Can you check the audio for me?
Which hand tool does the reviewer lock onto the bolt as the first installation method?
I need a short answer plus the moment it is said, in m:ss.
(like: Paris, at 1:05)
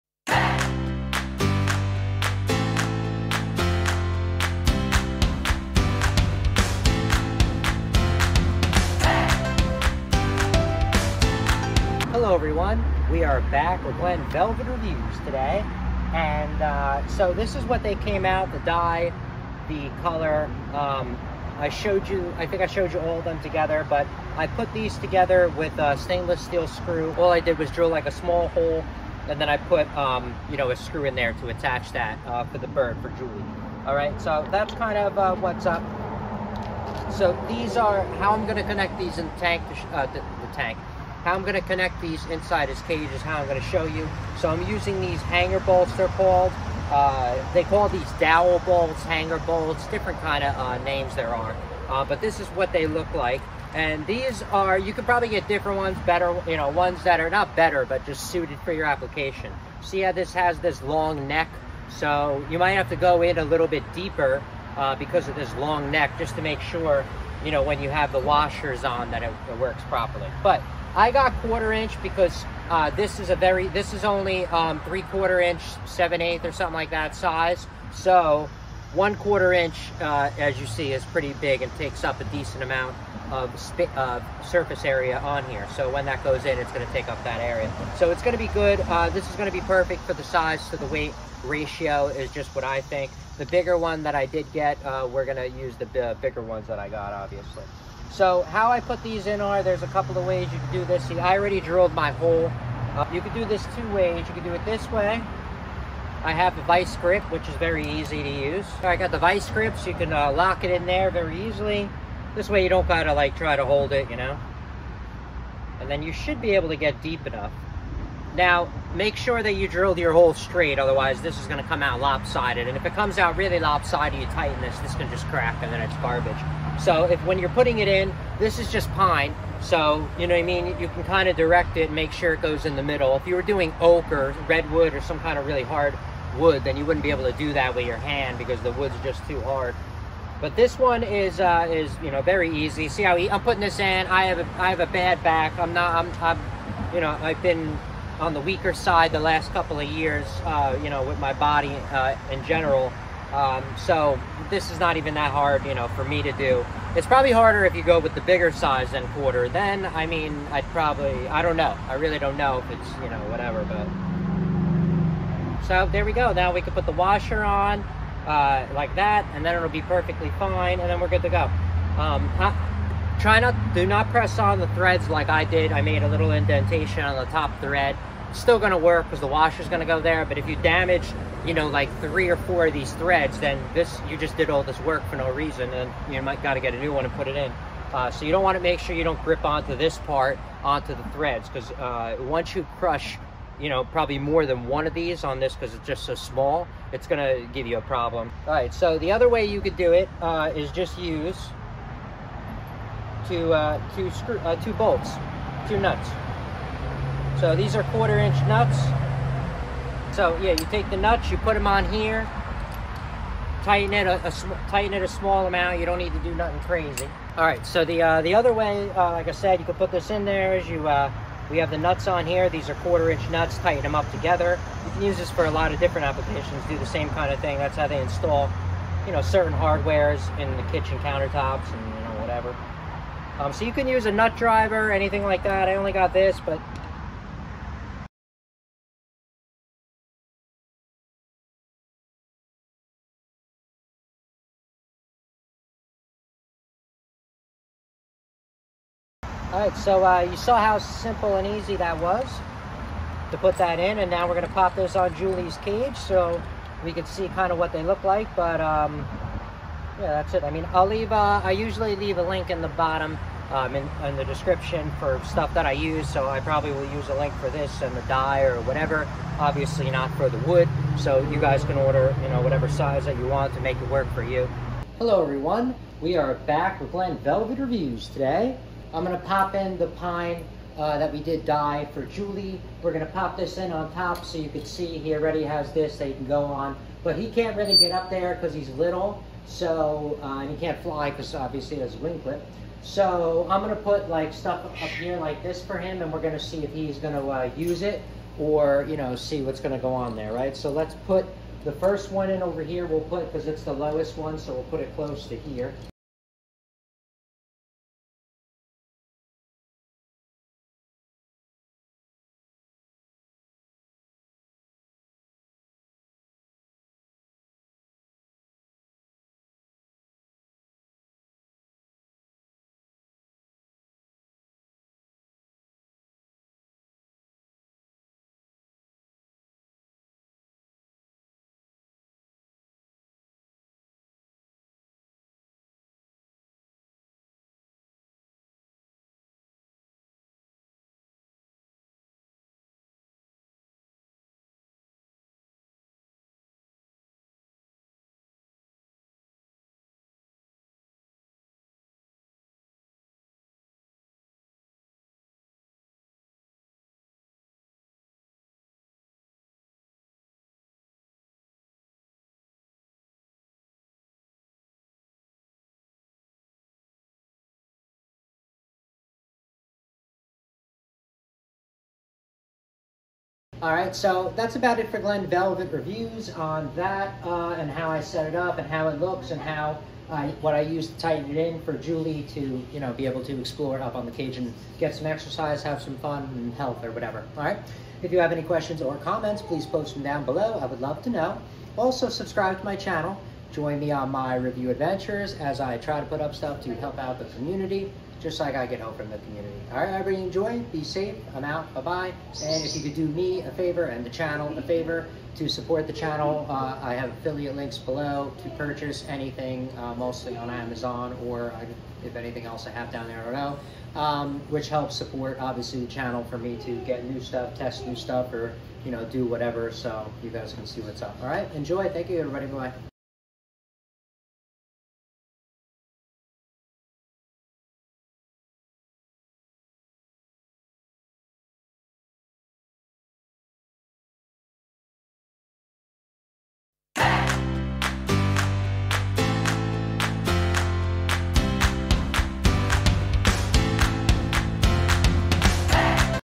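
vice grip, at 1:46.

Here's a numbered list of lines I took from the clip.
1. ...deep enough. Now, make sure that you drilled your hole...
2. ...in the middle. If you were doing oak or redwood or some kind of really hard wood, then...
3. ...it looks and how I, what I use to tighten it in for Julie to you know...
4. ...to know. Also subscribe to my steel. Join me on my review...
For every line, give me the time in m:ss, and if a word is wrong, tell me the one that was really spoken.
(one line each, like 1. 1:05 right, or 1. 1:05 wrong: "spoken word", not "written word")
1. 1:57 right
2. 2:12 right
3. 6:18 right
4. 6:31 wrong: "channel", not "steel".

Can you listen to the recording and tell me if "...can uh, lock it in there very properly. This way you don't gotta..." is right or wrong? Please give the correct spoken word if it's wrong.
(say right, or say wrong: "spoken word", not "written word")
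wrong: "easily", not "properly".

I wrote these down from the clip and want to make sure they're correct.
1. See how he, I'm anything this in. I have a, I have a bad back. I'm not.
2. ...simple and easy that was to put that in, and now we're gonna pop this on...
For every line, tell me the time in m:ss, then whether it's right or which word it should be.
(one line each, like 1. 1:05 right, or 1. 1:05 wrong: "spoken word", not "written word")
1. 2:22 wrong: "putting", not "anything"
2. 4:10 right.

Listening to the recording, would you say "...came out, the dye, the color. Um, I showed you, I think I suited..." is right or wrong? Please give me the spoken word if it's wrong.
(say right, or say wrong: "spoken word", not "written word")
wrong: "showed", not "suited".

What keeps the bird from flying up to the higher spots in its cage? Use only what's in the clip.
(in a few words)
a wing clip.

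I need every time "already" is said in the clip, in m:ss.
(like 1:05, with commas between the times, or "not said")
1:41, 4:45.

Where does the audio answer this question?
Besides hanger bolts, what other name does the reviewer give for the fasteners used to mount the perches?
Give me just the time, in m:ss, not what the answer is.
0:48.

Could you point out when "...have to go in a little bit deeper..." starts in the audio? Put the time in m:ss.
1:02.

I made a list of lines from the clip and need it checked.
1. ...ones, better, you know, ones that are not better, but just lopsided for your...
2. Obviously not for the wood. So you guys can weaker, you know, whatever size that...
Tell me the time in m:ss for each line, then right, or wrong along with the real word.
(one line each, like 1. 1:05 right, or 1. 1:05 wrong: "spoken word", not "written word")
1. 0:55 wrong: "suited", not "lopsided"
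2. 4:29 wrong: "order", not "weaker".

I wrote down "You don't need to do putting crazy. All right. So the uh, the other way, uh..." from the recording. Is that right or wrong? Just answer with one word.
wrong.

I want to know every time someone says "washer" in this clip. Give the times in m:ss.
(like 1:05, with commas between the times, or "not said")
1:08, 2:46, 2:59.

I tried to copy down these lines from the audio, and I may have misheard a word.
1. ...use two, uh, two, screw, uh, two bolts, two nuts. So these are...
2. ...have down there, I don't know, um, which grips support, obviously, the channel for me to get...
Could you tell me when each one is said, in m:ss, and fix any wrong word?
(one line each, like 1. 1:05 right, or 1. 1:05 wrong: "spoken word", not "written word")
1. 3:20 right
2. 6:52 wrong: "helps", not "grips".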